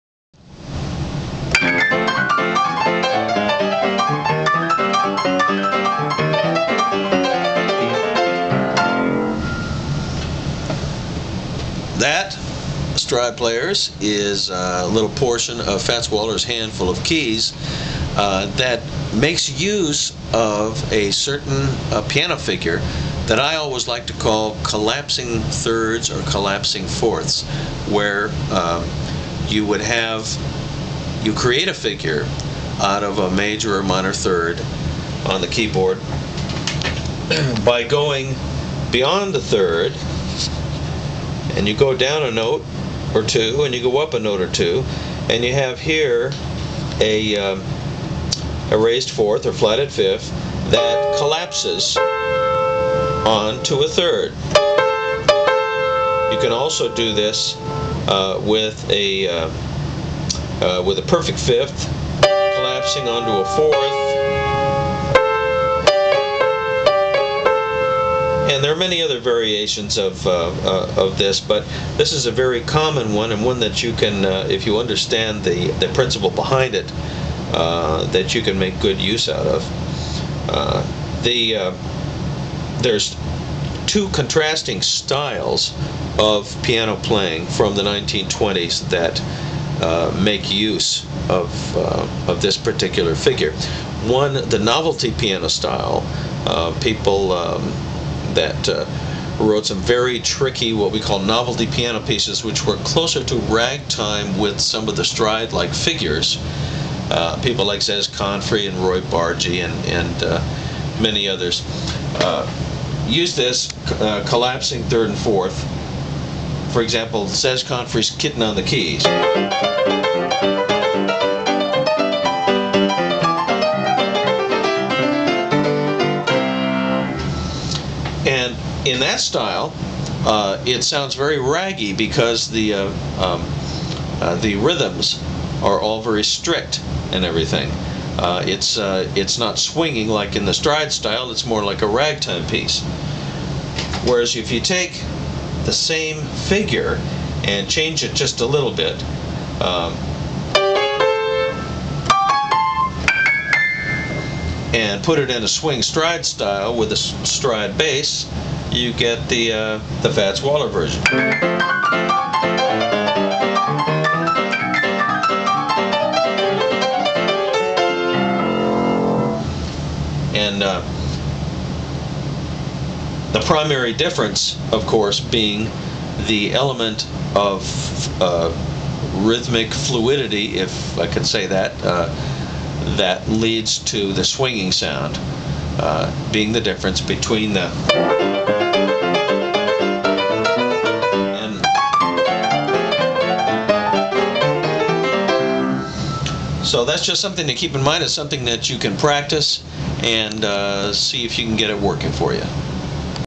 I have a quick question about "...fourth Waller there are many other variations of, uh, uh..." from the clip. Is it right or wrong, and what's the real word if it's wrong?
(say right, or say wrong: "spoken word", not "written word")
wrong: "And", not "Waller".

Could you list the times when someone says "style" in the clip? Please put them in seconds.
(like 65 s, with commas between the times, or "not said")
84 s, 95 s, 129 s, 140 s, 156 s.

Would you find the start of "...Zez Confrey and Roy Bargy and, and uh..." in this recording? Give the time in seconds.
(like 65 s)
107 s.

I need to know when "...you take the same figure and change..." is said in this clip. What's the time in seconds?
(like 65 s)
144 s.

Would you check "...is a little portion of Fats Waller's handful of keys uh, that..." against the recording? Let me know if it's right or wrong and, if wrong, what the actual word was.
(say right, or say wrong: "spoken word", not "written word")
right.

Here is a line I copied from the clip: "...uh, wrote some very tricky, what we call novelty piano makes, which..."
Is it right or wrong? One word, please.
wrong.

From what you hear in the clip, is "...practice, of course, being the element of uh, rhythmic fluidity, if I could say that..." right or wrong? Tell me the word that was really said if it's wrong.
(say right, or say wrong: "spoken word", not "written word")
wrong: "difference", not "practice".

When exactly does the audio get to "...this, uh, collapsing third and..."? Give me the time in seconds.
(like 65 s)
113 s.